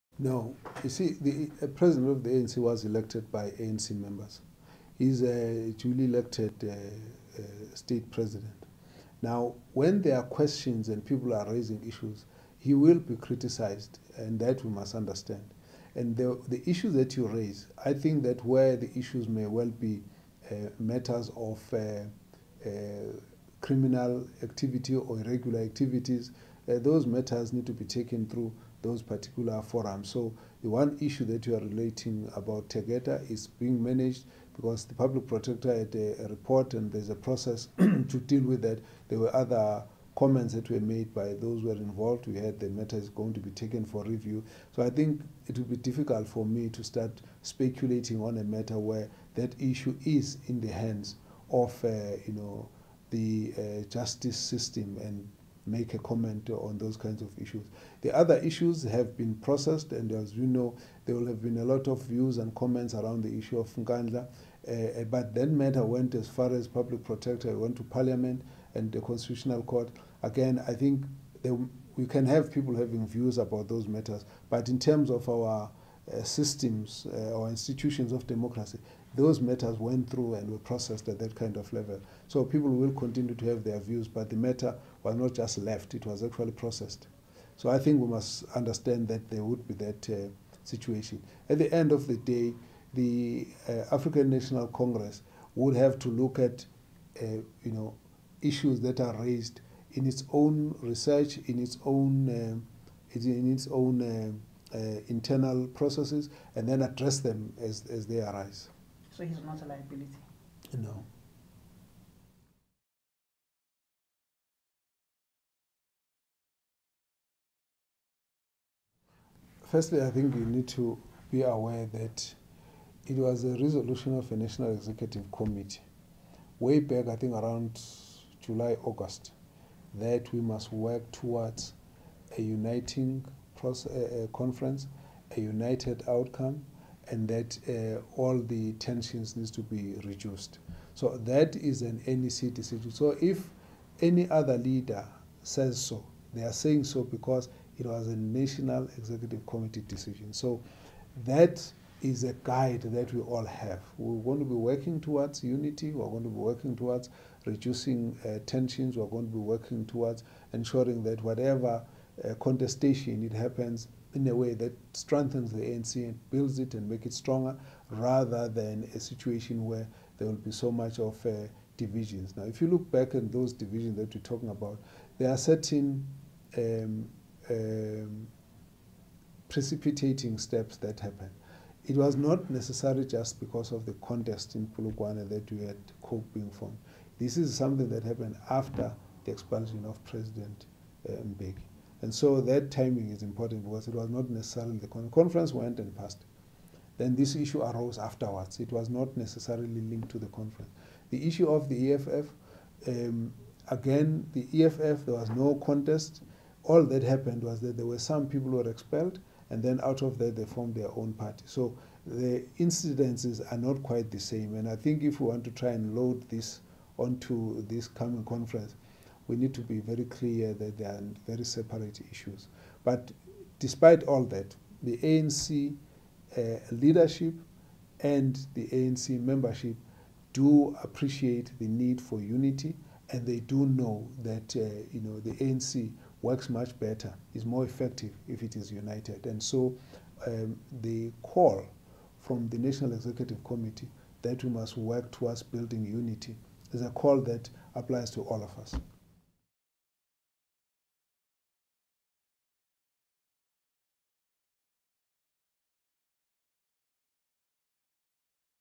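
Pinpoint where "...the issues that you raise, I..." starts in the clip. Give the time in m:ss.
0:16.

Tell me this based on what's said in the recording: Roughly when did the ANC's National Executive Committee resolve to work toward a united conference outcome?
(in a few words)
July, August.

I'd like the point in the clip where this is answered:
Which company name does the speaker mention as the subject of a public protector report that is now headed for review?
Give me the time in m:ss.
0:32.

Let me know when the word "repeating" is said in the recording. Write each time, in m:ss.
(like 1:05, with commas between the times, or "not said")
not said.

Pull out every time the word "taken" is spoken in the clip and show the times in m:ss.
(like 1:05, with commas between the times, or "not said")
0:27, 0:43.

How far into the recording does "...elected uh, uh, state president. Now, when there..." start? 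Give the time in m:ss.
0:06.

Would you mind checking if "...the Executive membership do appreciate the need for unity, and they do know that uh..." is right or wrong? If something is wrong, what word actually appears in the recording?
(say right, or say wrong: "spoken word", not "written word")
wrong: "ANC", not "Executive".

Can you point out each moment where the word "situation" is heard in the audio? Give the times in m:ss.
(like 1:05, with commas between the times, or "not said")
1:30, 2:48.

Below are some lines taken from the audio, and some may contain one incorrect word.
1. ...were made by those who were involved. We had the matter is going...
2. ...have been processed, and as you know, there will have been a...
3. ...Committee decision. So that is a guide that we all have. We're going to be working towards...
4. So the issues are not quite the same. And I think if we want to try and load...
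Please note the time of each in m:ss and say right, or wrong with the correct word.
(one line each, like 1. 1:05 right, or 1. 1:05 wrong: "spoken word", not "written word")
1. 0:40 right
2. 0:58 right
3. 2:29 right
4. 3:31 wrong: "incidences", not "issues".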